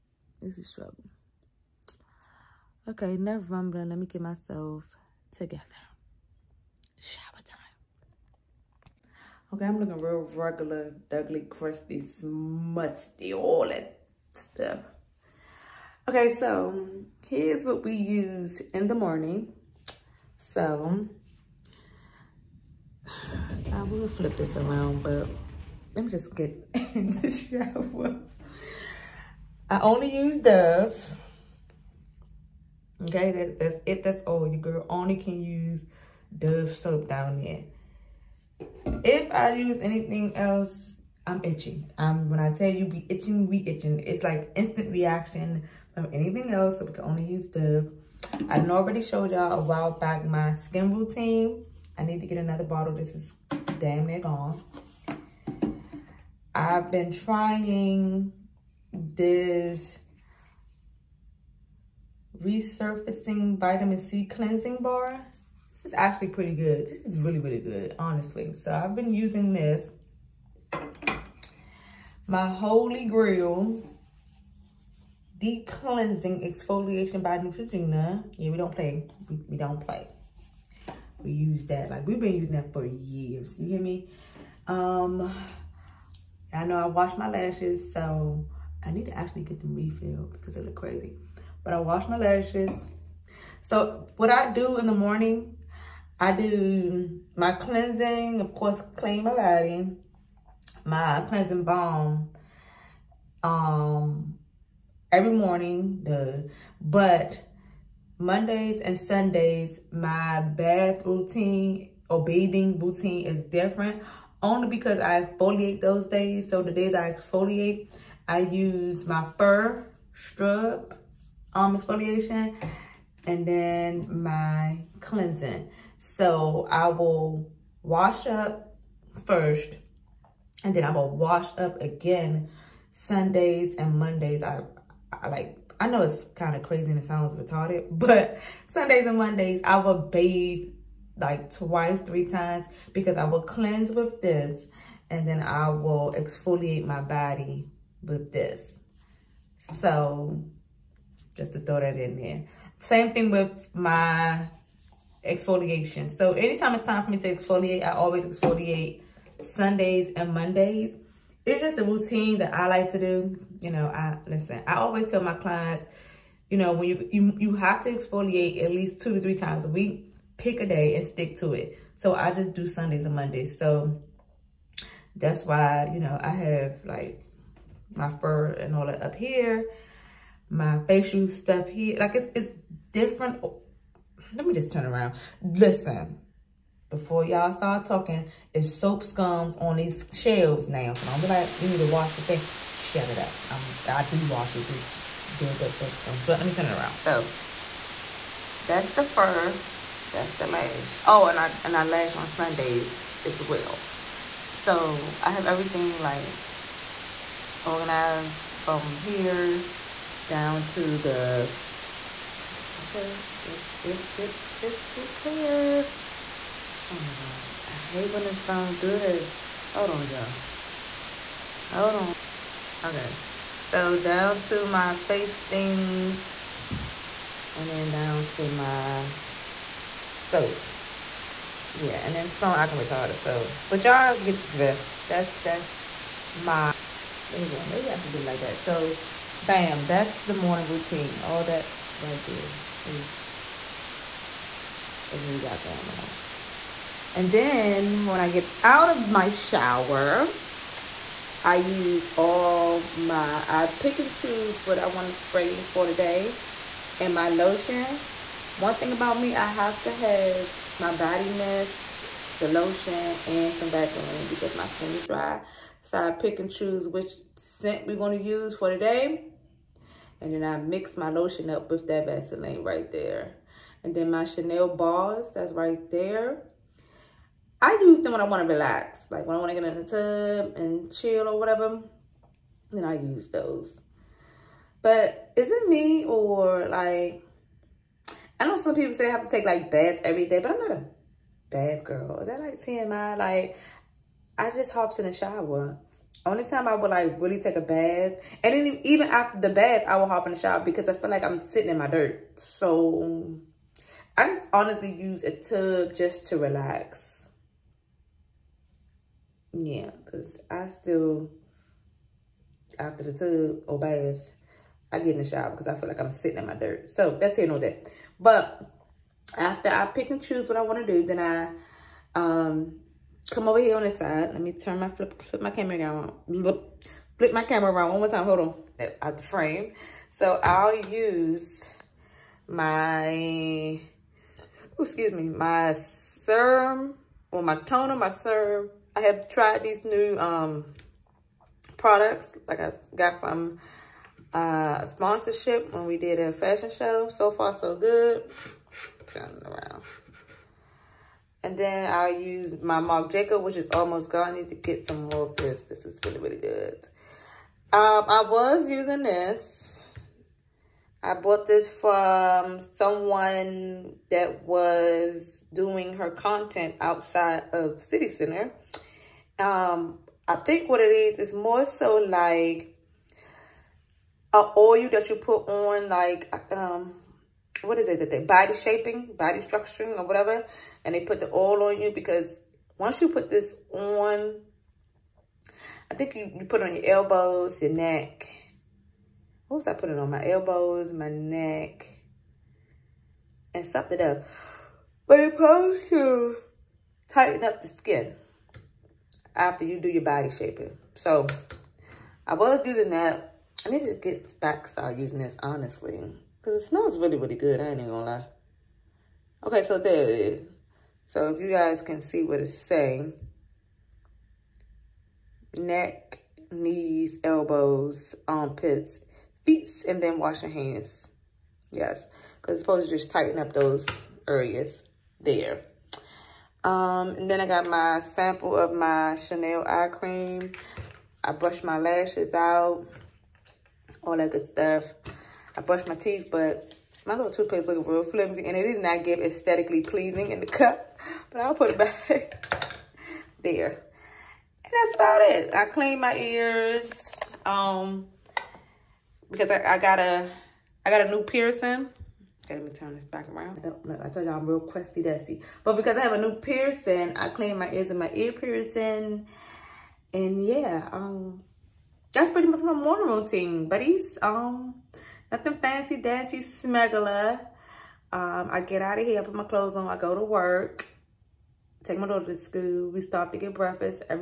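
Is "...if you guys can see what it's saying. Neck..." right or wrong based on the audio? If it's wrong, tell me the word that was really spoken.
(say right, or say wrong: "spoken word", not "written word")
right.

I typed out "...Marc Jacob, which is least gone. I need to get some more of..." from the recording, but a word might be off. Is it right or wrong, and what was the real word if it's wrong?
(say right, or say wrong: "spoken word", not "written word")
wrong: "almost", not "least".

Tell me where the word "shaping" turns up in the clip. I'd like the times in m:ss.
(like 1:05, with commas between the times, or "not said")
6:18, 6:40.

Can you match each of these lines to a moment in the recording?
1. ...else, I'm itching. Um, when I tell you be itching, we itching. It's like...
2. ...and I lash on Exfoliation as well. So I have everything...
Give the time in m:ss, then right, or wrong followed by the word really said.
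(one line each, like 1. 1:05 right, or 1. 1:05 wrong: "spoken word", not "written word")
1. 0:40 right
2. 3:21 wrong: "Sundays", not "Exfoliation".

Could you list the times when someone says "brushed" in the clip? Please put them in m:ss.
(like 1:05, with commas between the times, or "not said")
7:11, 7:15.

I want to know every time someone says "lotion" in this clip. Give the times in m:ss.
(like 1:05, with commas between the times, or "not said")
4:17, 4:22, 4:31.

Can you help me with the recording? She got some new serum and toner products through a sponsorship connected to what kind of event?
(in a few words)
A fashion show.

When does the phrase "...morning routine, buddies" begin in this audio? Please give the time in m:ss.
7:42.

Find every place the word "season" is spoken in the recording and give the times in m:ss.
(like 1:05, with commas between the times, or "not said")
not said.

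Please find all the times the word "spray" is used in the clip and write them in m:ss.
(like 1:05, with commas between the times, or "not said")
4:15.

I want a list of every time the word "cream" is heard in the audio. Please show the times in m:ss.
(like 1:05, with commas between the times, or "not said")
7:09.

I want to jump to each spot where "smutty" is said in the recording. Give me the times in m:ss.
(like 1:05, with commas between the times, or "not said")
0:12.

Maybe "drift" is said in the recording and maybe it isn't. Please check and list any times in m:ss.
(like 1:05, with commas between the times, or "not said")
3:54.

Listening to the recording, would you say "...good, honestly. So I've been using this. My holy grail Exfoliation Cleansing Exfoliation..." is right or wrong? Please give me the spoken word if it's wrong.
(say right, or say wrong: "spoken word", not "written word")
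wrong: "Deep", not "Exfoliation".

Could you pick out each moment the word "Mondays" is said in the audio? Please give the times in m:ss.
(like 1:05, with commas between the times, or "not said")
1:48, 2:13, 2:19, 2:40, 2:53.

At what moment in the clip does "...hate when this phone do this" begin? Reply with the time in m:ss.
3:37.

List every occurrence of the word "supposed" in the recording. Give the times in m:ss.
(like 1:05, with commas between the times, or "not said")
6:35, 7:02.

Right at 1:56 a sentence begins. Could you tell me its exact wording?
So the days I exfoliate, I use my fur scrub um, exfoliation and then my cleansing.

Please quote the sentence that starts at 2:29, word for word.
So just to throw that in there.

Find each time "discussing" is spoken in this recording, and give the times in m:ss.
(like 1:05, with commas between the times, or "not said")
not said.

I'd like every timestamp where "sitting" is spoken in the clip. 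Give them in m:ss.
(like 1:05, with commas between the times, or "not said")
5:01, 5:16.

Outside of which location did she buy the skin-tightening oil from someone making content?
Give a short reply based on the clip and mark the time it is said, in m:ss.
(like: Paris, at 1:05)
City Center, at 6:07.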